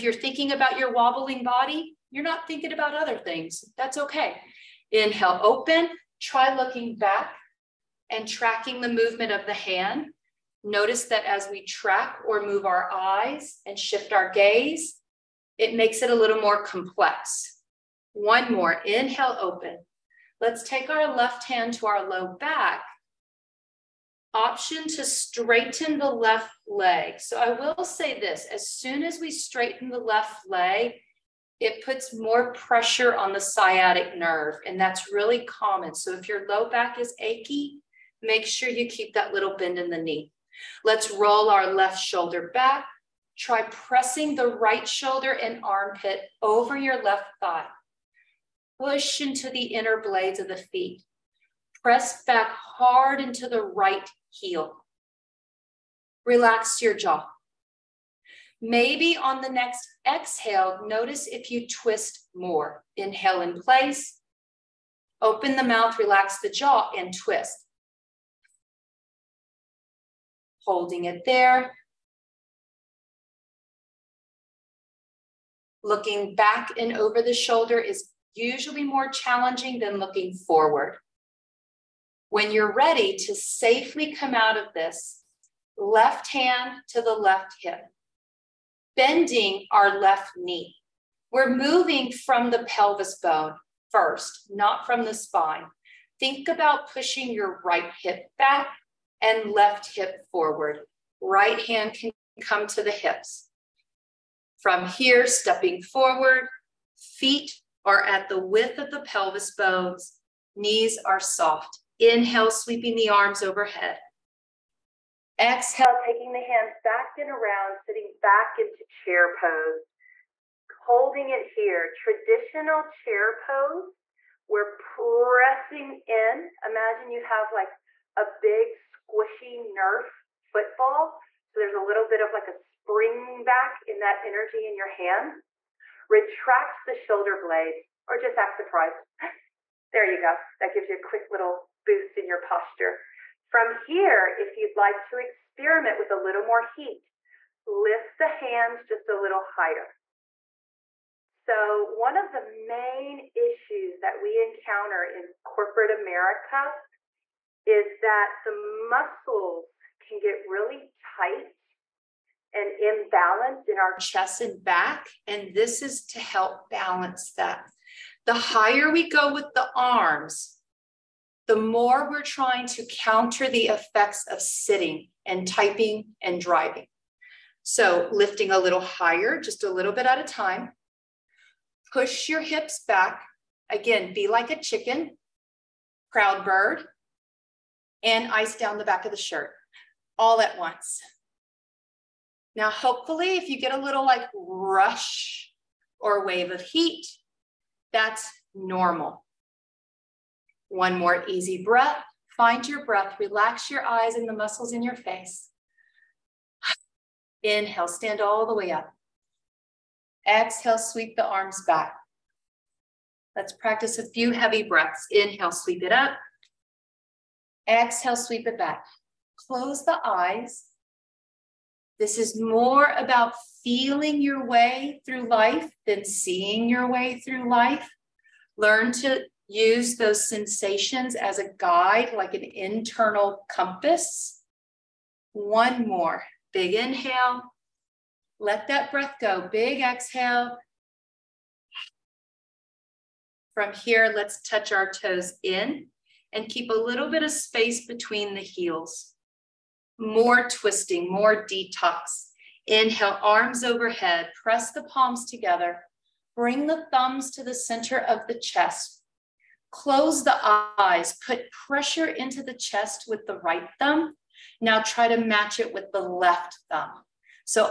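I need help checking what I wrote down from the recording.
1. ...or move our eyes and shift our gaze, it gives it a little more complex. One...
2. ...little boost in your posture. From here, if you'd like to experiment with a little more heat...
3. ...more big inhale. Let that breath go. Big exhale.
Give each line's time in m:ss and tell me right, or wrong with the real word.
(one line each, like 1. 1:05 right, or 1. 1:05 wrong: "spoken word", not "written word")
1. 0:12 wrong: "makes", not "gives"
2. 2:21 right
3. 3:55 right.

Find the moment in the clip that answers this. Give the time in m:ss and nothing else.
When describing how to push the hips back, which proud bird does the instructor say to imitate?
3:04.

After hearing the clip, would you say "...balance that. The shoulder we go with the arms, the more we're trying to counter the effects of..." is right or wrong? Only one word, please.
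wrong.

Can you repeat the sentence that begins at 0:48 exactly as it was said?
Push into the inner blades of the feet.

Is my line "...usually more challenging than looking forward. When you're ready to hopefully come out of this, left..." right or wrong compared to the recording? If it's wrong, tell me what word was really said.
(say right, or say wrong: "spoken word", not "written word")
wrong: "safely", not "hopefully".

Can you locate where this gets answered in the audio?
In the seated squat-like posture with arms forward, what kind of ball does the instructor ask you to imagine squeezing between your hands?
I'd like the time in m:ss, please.
2:09.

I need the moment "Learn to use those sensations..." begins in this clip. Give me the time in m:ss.
3:48.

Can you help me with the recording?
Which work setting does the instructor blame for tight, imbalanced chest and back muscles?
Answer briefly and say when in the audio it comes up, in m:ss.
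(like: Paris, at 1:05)
corporate America, at 2:35.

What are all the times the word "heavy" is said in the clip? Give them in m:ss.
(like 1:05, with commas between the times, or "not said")
3:34.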